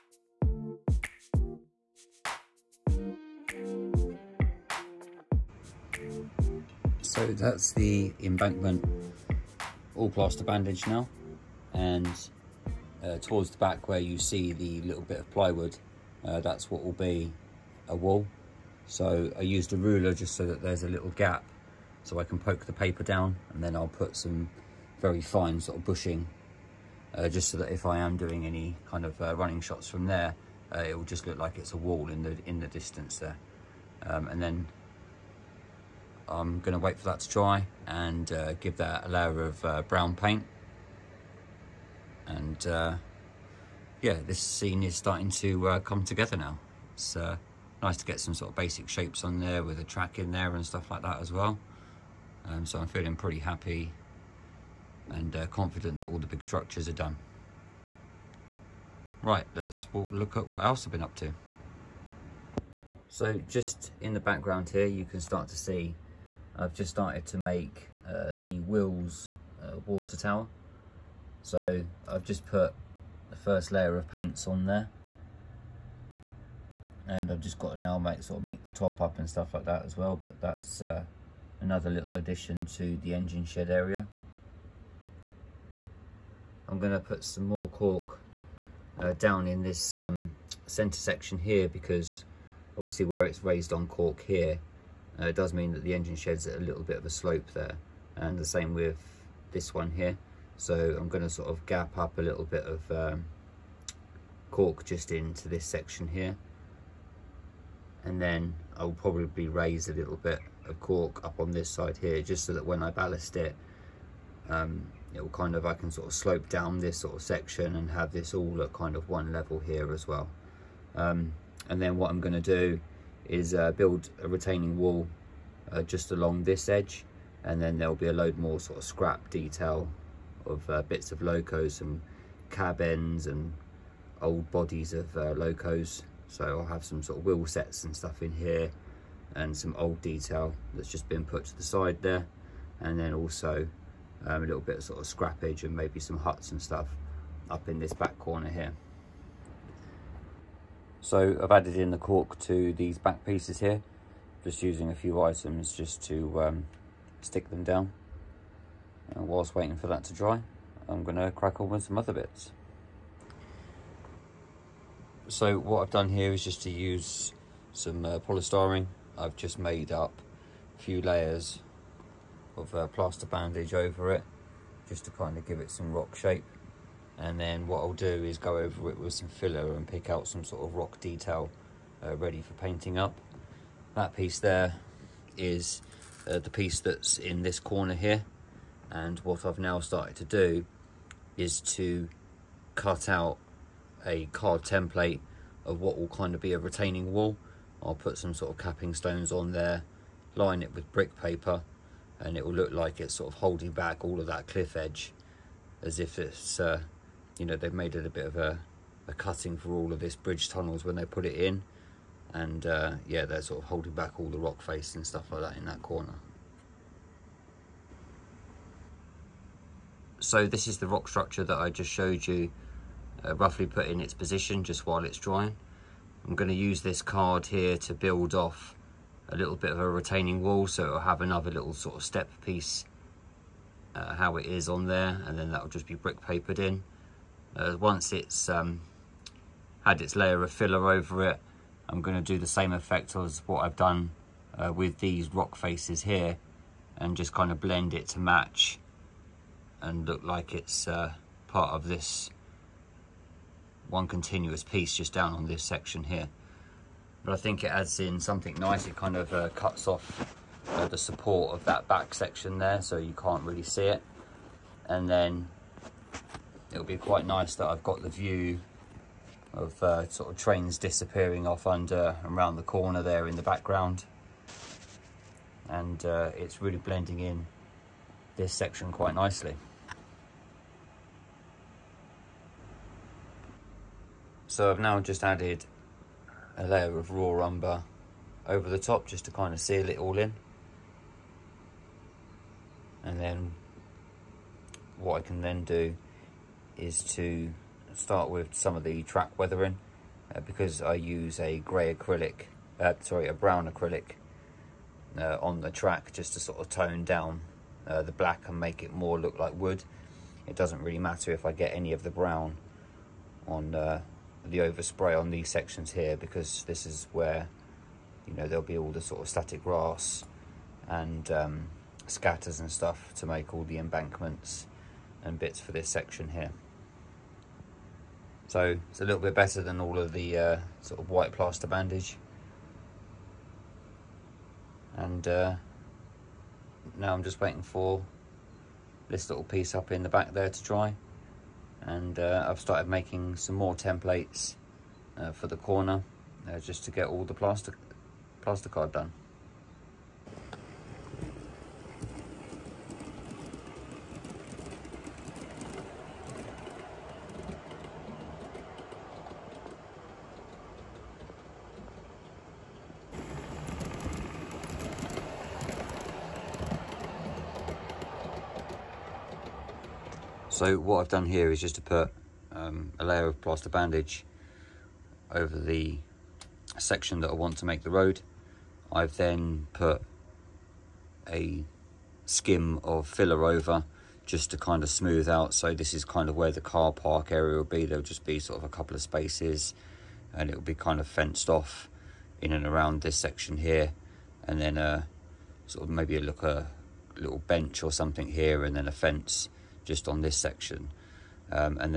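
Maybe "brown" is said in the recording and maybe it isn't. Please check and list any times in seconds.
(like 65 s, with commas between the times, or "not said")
39 s, 303 s, 312 s.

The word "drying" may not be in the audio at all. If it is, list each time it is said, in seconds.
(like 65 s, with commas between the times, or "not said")
225 s.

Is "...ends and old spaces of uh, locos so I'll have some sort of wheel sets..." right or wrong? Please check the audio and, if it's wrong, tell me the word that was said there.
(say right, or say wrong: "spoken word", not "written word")
wrong: "bodies", not "spaces".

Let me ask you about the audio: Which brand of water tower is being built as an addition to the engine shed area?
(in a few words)
Wills.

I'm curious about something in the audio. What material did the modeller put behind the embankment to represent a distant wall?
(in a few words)
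Plywood.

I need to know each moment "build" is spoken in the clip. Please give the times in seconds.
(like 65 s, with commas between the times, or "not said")
123 s, 227 s.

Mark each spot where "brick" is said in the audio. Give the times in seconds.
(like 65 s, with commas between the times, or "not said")
200 s, 235 s.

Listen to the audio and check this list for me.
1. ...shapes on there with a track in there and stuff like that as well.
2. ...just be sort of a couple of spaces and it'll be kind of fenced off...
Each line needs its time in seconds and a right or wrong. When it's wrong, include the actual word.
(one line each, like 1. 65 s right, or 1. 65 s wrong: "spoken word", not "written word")
1. 48 s right
2. 388 s right.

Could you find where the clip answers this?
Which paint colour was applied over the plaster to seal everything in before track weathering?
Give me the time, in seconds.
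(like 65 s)
287 s.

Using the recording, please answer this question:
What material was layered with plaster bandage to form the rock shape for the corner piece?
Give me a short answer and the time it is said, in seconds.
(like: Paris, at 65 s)
Polystyrene, at 168 s.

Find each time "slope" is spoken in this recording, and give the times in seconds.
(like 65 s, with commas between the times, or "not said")
97 s, 116 s.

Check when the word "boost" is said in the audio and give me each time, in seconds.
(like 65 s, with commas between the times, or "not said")
not said.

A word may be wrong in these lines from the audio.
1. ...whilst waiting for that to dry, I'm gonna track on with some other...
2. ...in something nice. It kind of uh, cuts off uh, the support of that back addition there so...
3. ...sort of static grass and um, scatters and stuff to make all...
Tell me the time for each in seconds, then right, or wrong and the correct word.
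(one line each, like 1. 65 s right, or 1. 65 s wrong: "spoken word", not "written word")
1. 159 s wrong: "crack", not "track"
2. 257 s wrong: "section", not "addition"
3. 319 s right.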